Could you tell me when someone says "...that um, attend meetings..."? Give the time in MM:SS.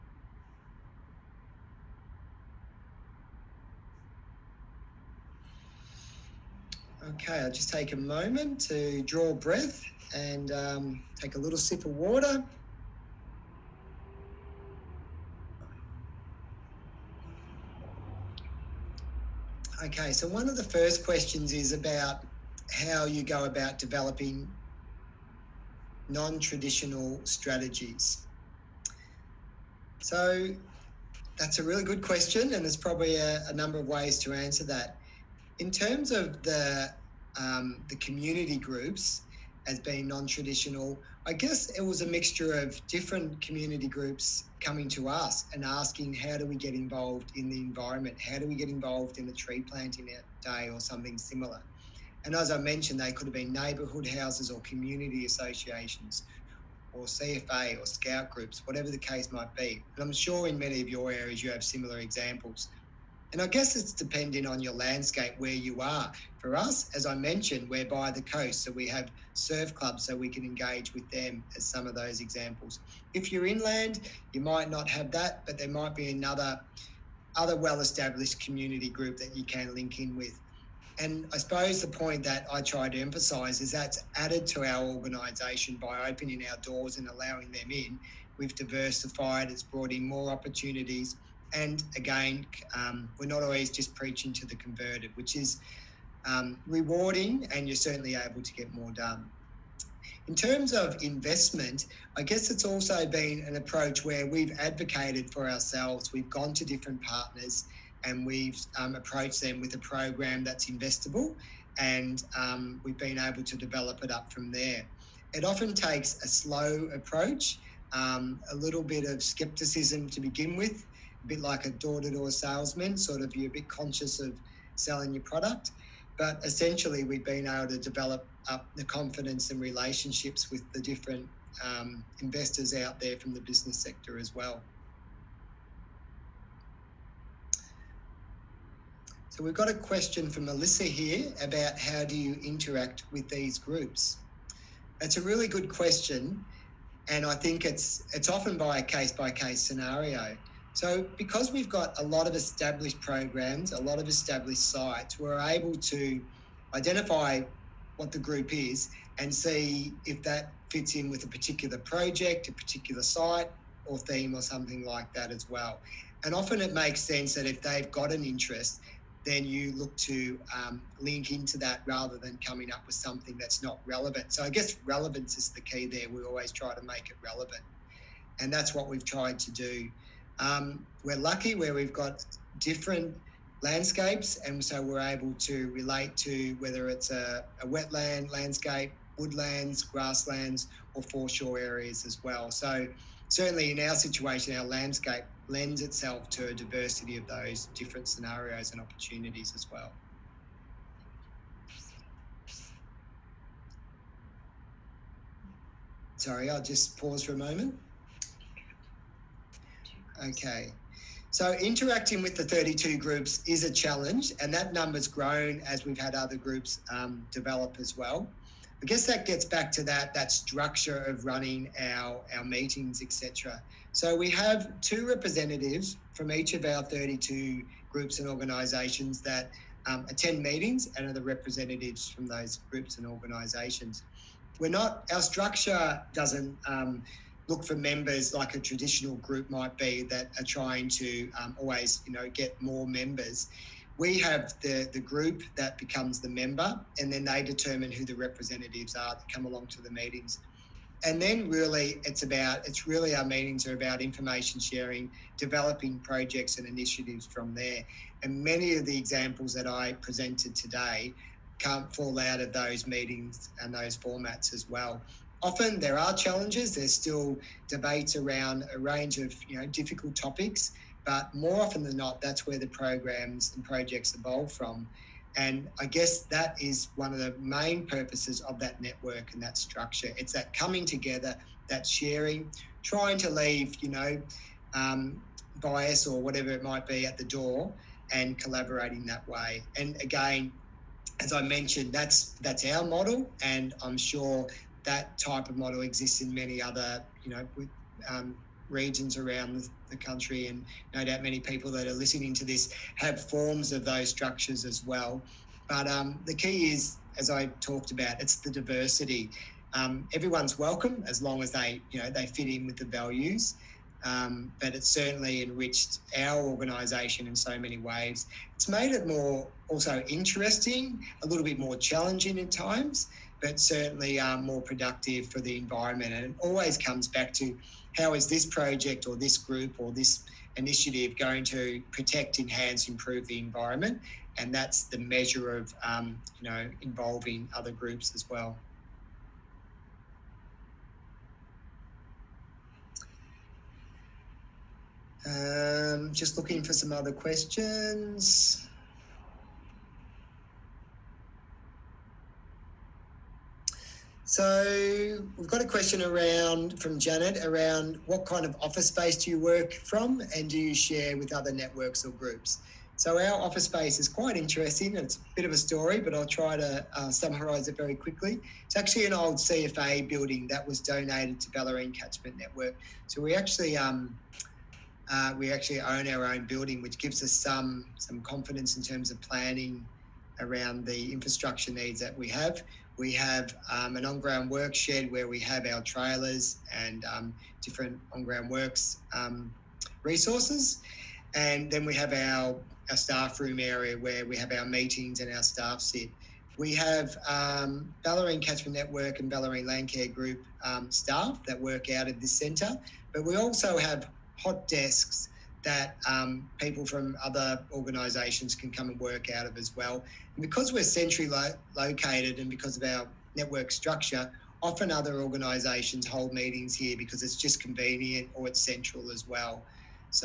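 03:49.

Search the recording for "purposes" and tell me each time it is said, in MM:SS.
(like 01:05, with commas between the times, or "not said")
04:37.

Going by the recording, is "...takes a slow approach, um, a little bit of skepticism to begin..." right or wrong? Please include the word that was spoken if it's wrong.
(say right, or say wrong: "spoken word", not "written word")
right.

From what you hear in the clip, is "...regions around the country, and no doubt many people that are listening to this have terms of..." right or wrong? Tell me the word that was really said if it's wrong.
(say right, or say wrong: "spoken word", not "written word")
wrong: "forms", not "terms".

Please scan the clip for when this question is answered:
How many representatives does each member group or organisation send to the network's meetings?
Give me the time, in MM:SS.
03:44.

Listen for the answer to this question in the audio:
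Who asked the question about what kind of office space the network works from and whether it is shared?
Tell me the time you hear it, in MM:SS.
05:56.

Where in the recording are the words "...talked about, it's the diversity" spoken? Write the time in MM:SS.
05:07.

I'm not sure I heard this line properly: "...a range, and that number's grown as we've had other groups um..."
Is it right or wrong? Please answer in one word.
wrong.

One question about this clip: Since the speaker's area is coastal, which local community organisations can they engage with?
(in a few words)
surf clubs.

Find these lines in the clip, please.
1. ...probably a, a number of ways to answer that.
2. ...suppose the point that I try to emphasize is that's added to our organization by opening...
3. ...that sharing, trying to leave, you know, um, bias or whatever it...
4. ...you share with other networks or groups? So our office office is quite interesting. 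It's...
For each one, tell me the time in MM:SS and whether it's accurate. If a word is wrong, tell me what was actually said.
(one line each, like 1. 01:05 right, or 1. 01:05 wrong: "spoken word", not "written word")
1. 00:32 right
2. 01:21 right
3. 04:41 right
4. 06:00 wrong: "space", not "office".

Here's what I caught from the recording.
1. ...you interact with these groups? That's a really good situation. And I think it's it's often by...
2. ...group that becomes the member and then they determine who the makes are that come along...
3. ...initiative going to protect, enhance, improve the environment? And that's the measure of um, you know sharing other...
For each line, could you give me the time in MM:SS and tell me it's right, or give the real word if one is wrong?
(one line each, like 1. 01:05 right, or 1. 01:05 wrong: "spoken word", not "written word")
1. 02:22 wrong: "question", not "situation"
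2. 04:04 wrong: "representatives", not "makes"
3. 05:30 wrong: "involving", not "sharing".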